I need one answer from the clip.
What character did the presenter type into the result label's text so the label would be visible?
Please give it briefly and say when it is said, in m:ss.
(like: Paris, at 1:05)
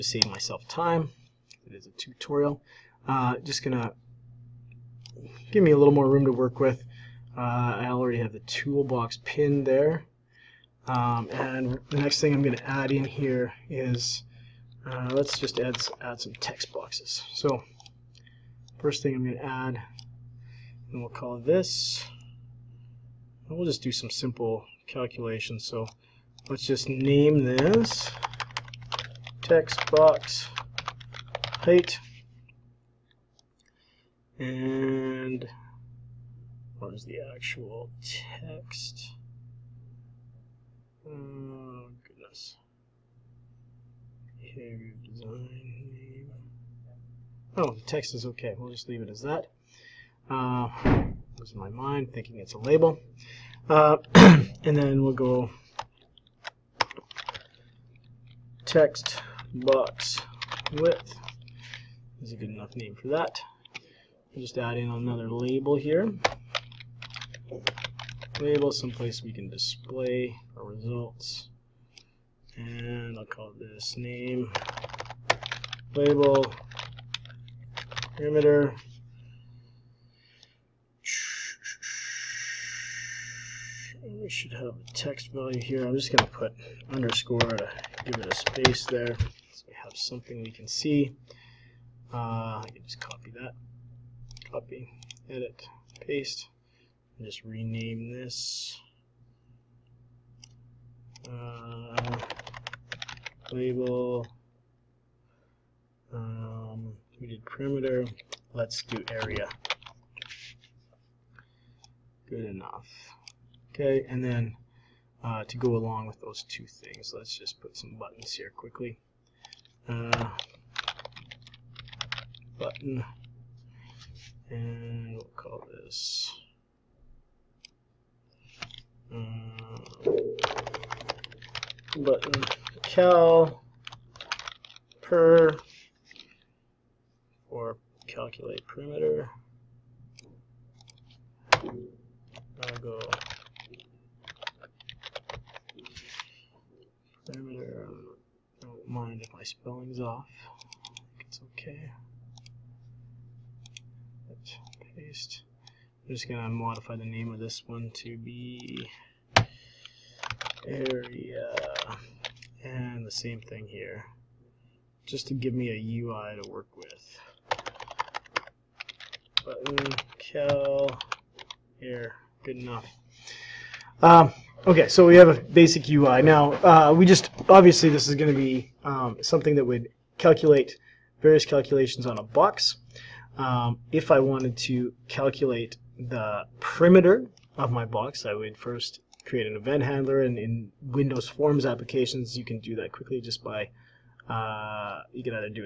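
underscore, at 1:26.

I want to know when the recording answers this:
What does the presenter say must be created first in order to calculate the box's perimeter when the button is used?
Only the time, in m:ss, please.
3:09.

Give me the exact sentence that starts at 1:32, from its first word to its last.
Uh, I can just copy that, copy, edit, paste, and just rename this uh, label.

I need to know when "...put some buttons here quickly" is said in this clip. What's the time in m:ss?
1:57.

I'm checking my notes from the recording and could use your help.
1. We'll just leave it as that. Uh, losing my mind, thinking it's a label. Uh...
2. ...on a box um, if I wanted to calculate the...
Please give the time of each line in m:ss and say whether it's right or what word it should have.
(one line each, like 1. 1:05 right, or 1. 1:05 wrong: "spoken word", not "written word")
1. 0:48 right
2. 3:02 right.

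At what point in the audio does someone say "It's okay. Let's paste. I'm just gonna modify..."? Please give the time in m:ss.
2:31.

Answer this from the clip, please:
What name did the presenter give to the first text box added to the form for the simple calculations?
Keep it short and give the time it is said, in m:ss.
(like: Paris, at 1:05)
height, at 0:31.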